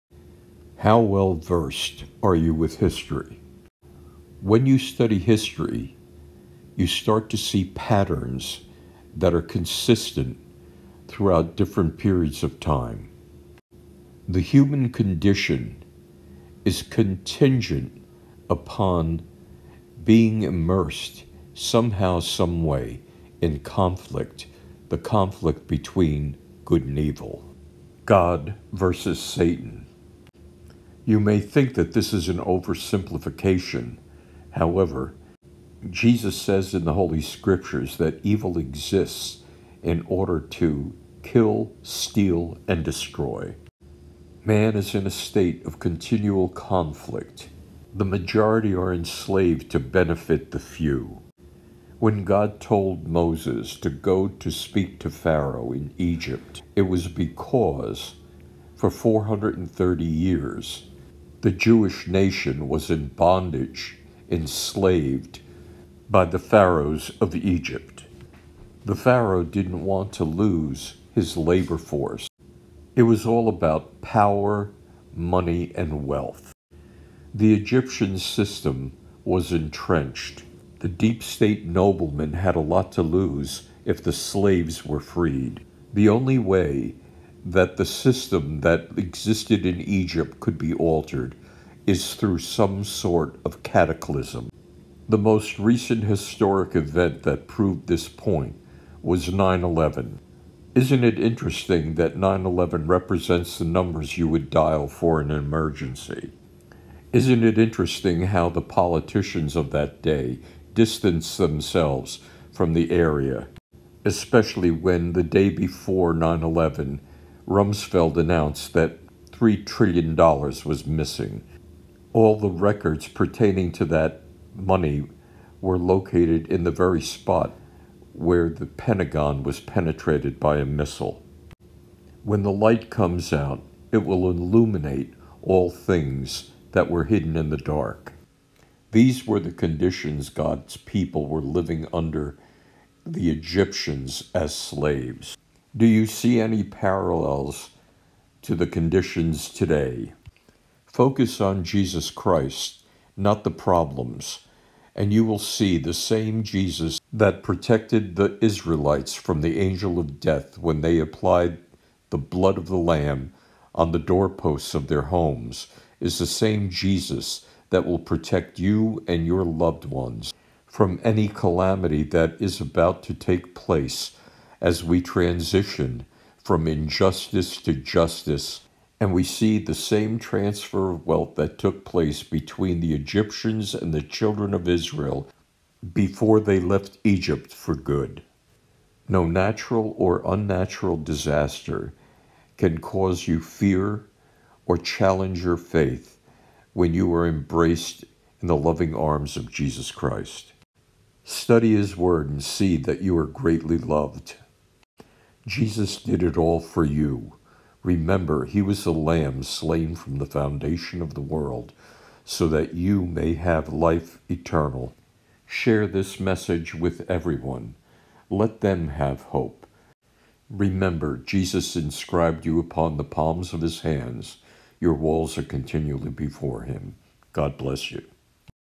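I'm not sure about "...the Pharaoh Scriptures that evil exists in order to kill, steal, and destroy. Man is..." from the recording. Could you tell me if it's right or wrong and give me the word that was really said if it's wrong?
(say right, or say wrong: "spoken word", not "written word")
wrong: "Holy", not "Pharaoh".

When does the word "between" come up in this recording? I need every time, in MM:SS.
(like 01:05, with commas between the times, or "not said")
00:25, 03:02.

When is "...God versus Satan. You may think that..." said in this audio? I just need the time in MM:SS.
00:28.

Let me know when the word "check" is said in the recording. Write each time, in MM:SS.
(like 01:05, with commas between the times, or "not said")
not said.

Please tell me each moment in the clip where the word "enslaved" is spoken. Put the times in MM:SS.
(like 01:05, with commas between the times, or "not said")
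00:48, 01:04.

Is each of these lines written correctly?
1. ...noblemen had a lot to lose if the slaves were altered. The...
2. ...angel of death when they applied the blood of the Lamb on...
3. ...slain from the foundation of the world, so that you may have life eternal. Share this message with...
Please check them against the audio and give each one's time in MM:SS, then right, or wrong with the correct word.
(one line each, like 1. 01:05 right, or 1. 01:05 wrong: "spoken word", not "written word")
1. 01:21 wrong: "freed", not "altered"
2. 02:39 right
3. 03:29 right.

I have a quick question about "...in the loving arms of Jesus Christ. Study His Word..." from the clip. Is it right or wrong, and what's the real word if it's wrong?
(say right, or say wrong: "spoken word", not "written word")
right.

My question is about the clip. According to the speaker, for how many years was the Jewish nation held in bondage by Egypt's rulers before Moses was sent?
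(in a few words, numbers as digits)
430 years.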